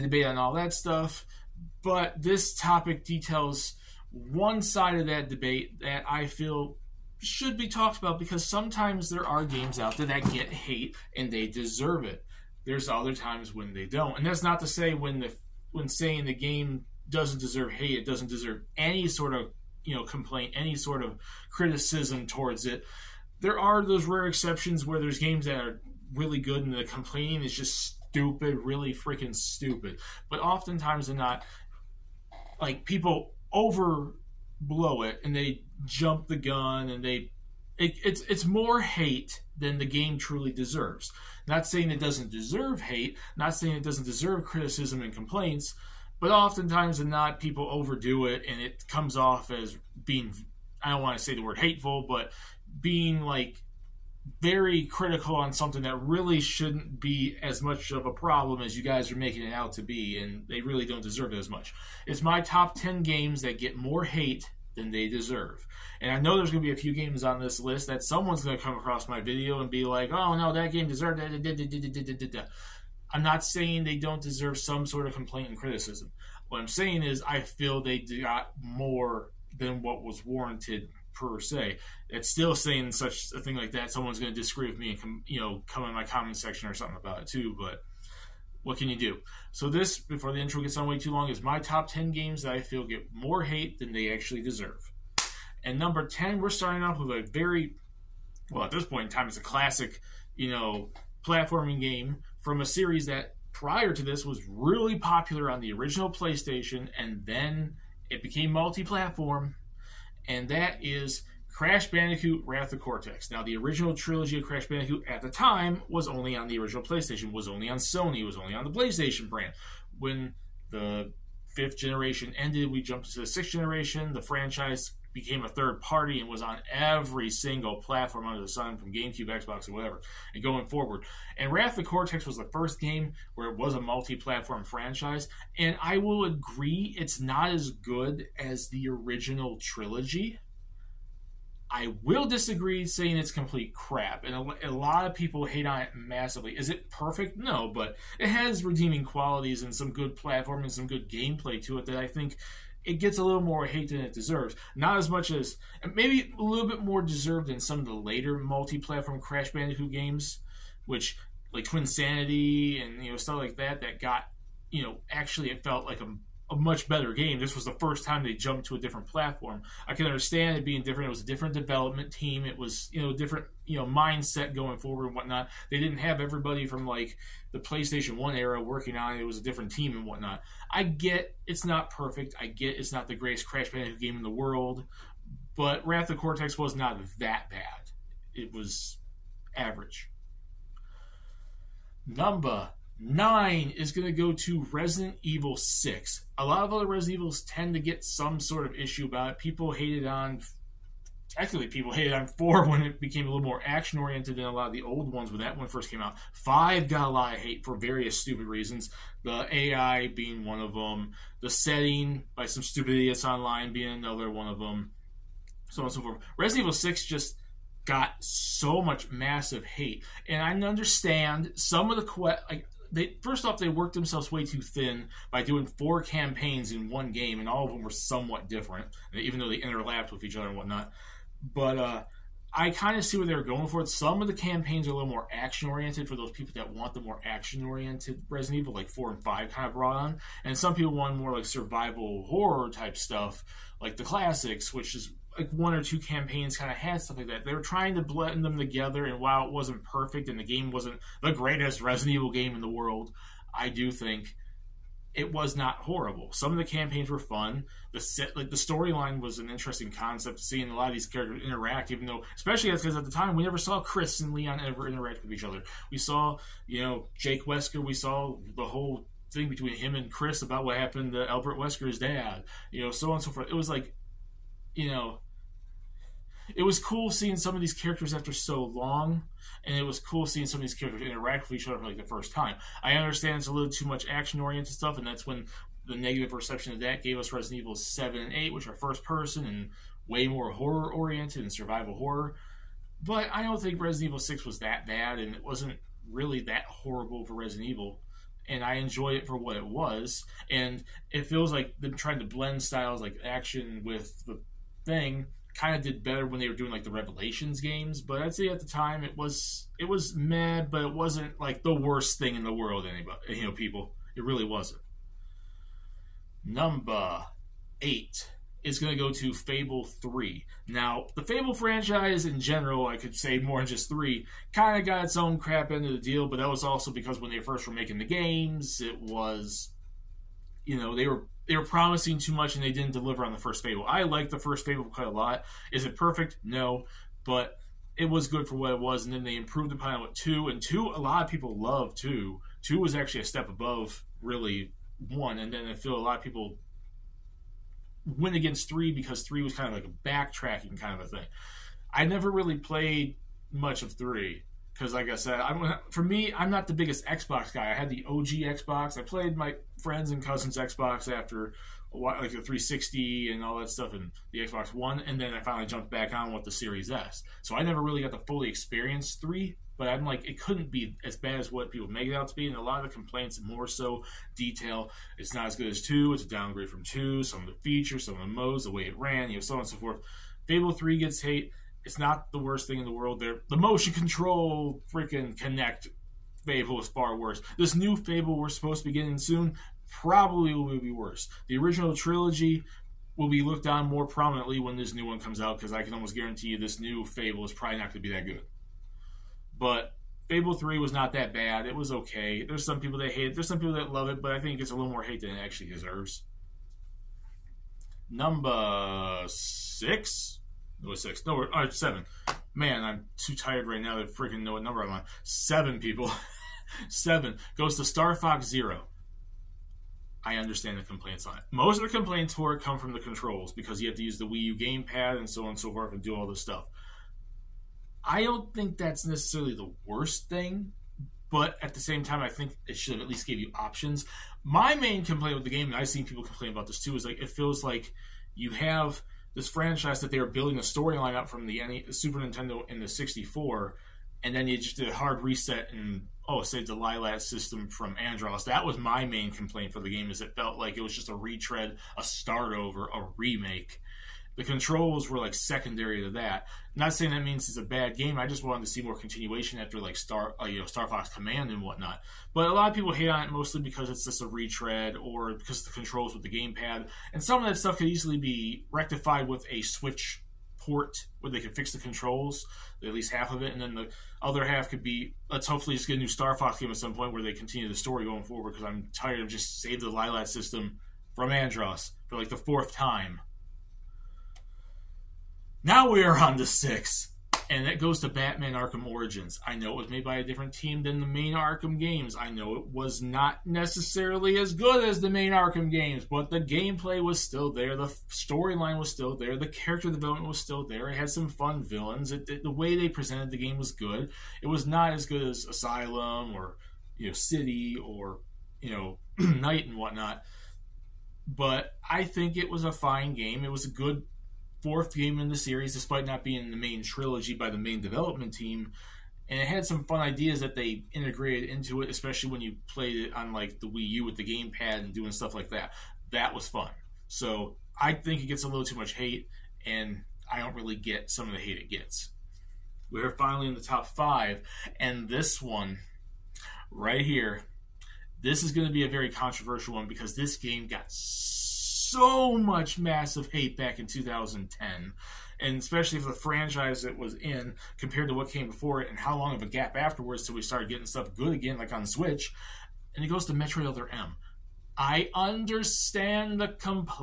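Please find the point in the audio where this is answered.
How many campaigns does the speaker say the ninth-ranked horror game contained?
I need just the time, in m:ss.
3:45.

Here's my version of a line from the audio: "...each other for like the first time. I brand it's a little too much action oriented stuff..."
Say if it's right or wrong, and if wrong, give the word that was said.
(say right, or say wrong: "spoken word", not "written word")
wrong: "understand", not "brand".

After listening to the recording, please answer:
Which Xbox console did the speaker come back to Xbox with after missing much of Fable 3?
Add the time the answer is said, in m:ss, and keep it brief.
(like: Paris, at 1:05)
Series S, at 6:06.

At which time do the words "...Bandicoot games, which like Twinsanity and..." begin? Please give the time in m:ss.
2:39.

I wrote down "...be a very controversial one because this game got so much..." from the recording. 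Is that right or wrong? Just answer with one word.
right.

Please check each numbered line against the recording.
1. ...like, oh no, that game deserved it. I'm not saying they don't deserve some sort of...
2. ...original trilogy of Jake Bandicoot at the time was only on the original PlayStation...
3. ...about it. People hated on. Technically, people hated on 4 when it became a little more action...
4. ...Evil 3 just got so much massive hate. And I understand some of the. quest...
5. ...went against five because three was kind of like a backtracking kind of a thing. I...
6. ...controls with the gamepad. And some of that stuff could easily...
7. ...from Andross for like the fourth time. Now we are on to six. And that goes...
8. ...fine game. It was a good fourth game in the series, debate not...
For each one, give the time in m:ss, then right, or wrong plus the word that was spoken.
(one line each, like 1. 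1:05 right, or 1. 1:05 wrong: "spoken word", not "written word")
1. 1:09 right
2. 1:53 wrong: "Crash", not "Jake"
3. 3:19 right
4. 3:36 wrong: "6", not "3"
5. 5:48 wrong: "three", not "five"
6. 7:45 right
7. 8:01 right
8. 8:32 wrong: "despite", not "debate".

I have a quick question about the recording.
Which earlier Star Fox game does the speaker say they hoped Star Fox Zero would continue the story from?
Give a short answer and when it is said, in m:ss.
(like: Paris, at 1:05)
Star Fox Command, at 7:40.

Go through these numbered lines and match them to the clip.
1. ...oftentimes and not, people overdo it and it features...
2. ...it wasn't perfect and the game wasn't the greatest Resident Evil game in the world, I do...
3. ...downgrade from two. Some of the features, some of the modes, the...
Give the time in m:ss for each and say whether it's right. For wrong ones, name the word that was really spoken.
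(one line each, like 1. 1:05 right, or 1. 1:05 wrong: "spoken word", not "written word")
1. 0:46 wrong: "comes", not "features"
2. 4:09 right
3. 6:16 right.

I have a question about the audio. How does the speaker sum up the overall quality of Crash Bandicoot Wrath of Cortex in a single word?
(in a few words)
Average.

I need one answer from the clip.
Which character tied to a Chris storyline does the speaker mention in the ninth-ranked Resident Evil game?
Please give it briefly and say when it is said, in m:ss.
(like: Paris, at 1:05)
Jake Wesker, at 4:27.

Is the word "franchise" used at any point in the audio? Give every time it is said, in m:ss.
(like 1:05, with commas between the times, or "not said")
2:04, 2:14, 5:21, 7:19, 9:06.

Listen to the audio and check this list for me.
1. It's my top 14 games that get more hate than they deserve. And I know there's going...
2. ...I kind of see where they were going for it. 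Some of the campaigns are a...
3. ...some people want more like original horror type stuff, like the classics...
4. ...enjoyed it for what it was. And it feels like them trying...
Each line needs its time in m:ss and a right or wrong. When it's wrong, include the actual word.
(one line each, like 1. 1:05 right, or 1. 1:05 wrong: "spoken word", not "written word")
1. 1:02 wrong: "10", not "14"
2. 3:52 right
3. 4:00 wrong: "survival", not "original"
4. 4:58 right.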